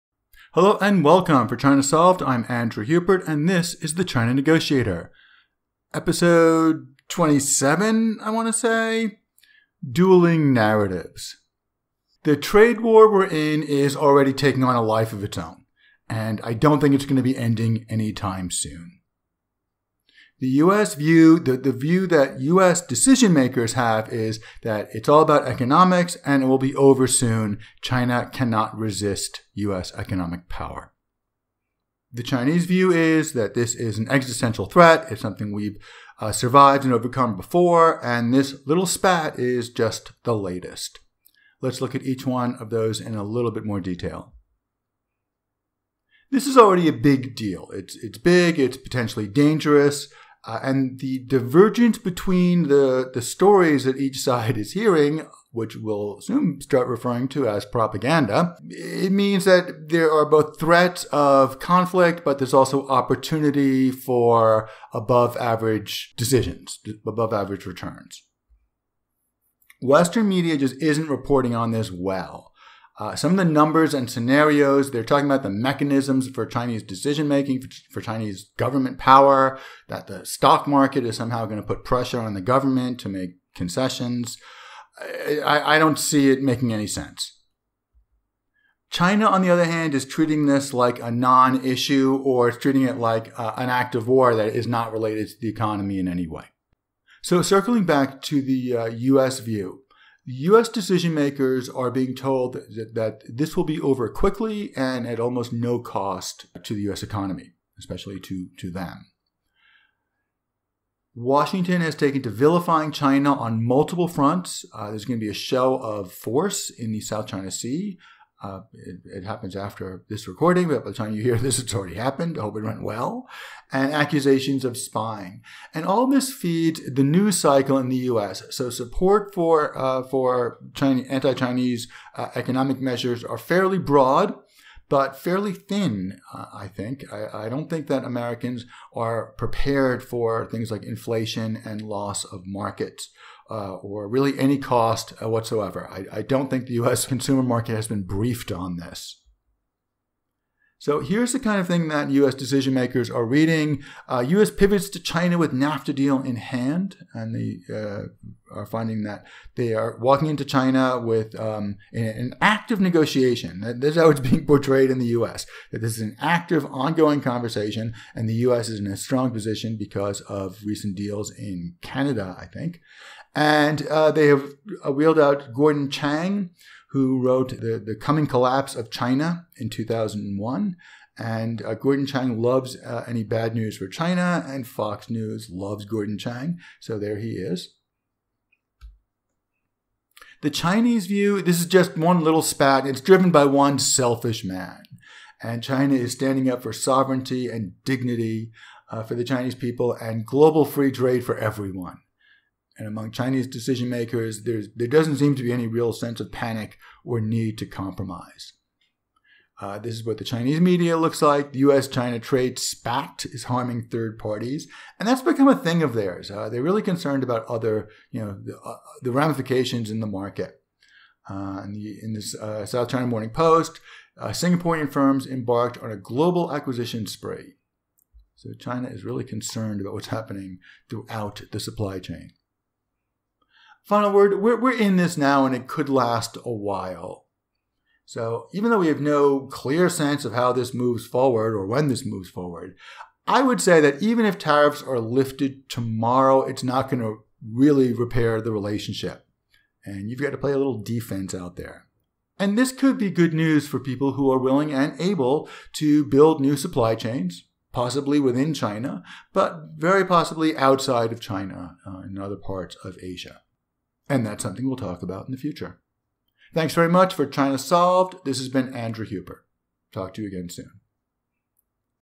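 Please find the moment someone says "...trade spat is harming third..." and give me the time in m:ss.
3:32.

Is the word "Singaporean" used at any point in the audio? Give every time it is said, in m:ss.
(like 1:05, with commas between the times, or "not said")
3:44.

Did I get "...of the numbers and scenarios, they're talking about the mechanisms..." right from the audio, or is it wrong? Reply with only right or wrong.
right.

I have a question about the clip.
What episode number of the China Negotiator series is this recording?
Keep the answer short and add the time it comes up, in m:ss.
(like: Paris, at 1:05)
27, at 0:05.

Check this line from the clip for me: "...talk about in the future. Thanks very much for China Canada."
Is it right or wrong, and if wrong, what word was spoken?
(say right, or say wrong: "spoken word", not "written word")
wrong: "Solved", not "Canada".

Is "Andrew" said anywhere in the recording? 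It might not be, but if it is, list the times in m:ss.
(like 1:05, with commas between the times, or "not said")
0:02, 4:28.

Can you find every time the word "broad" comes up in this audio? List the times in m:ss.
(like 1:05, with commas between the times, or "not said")
2:13.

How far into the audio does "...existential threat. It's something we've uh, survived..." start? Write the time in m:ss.
0:34.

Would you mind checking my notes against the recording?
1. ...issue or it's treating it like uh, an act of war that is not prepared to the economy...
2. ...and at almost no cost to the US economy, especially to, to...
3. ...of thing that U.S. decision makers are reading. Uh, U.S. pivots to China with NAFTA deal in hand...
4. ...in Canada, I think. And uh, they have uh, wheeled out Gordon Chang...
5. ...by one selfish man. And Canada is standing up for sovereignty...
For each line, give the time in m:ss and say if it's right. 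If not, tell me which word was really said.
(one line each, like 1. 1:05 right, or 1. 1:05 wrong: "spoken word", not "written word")
1. 1:31 wrong: "related", not "prepared"
2. 1:44 right
3. 2:31 right
4. 2:51 right
5. 3:13 wrong: "China", not "Canada".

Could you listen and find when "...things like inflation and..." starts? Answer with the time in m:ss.
2:20.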